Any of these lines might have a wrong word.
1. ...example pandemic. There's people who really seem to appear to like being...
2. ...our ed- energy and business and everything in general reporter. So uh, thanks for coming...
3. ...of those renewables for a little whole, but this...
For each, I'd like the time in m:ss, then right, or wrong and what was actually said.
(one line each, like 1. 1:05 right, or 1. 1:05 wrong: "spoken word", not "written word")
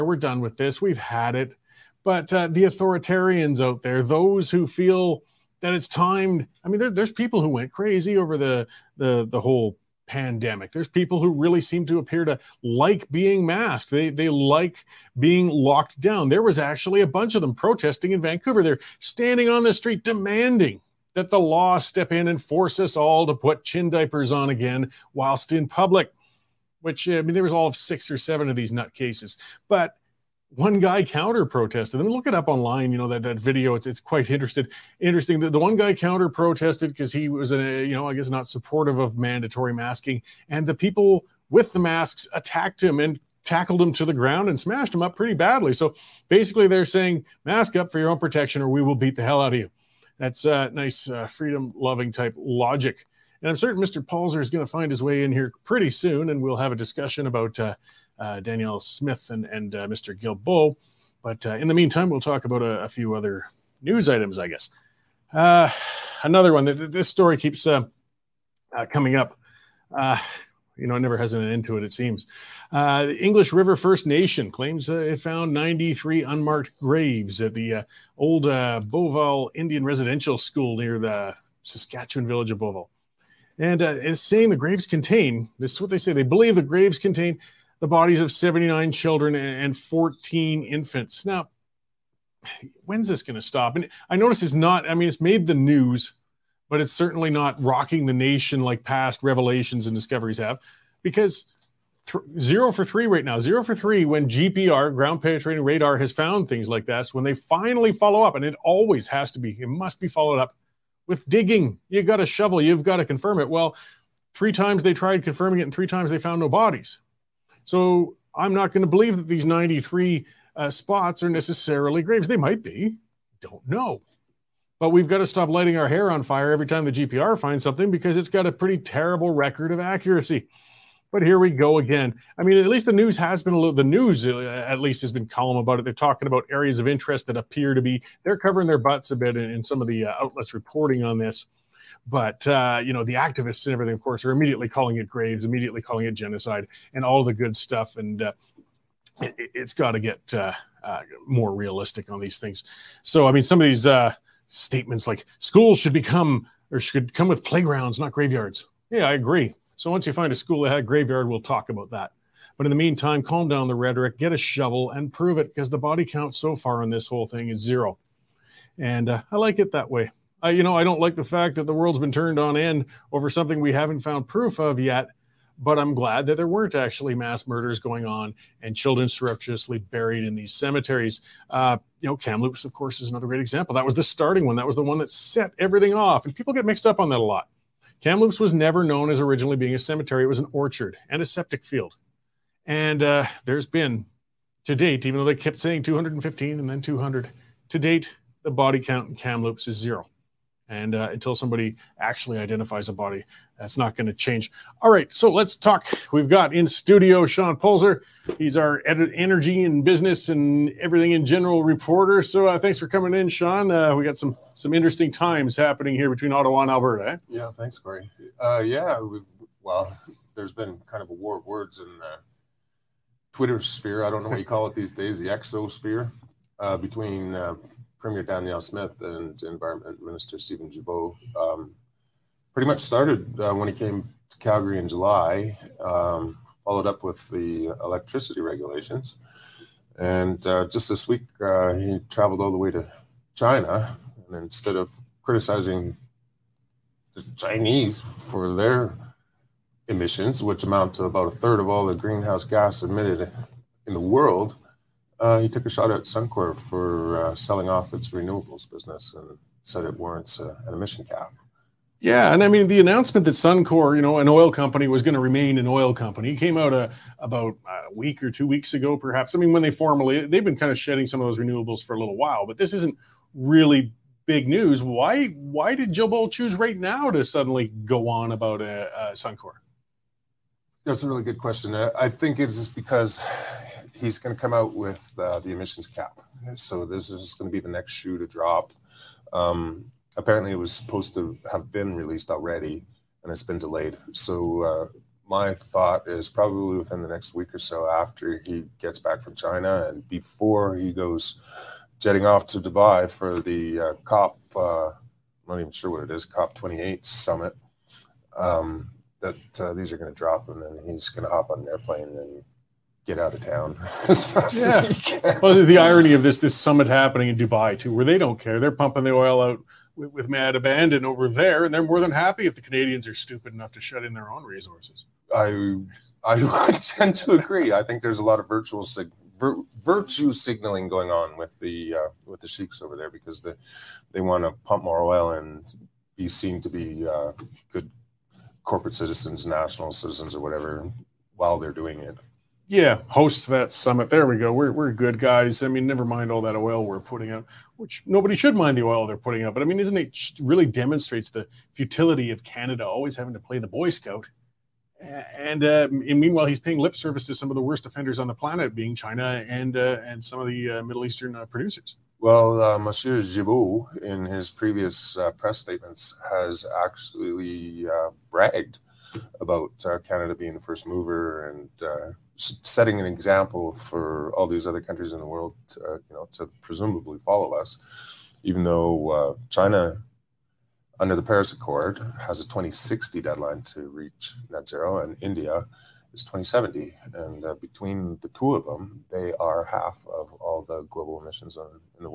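1. 0:09 wrong: "whole", not "example"
2. 3:28 right
3. 4:31 wrong: "while", not "whole".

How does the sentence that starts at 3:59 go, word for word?
And uh, just this week, uh, he traveled all the way to China.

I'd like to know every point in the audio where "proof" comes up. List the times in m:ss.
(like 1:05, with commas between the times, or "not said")
2:54.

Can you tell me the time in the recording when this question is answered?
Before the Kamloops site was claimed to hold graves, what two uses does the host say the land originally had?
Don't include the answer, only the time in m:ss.
3:10.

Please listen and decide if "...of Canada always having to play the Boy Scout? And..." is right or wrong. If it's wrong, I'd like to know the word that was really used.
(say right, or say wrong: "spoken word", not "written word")
right.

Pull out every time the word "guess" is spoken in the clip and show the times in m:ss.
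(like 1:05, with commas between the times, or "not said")
0:38, 1:04.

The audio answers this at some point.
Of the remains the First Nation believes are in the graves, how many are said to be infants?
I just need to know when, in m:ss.
1:29.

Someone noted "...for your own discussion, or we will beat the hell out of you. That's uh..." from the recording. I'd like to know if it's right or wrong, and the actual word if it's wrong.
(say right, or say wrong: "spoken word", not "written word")
wrong: "protection", not "discussion".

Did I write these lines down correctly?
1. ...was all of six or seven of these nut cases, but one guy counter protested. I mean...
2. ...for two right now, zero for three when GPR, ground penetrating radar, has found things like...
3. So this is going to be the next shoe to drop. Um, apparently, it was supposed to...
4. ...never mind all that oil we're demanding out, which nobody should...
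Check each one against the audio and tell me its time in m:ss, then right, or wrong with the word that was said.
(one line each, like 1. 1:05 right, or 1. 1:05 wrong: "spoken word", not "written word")
1. 0:27 right
2. 1:42 wrong: "three", not "two"
3. 4:46 right
4. 5:45 wrong: "putting", not "demanding".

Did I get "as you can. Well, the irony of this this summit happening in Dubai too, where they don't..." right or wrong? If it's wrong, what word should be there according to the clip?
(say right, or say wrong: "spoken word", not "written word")
right.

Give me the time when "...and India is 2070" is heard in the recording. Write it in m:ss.
6:24.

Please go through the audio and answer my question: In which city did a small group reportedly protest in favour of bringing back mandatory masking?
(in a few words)
Vancouver.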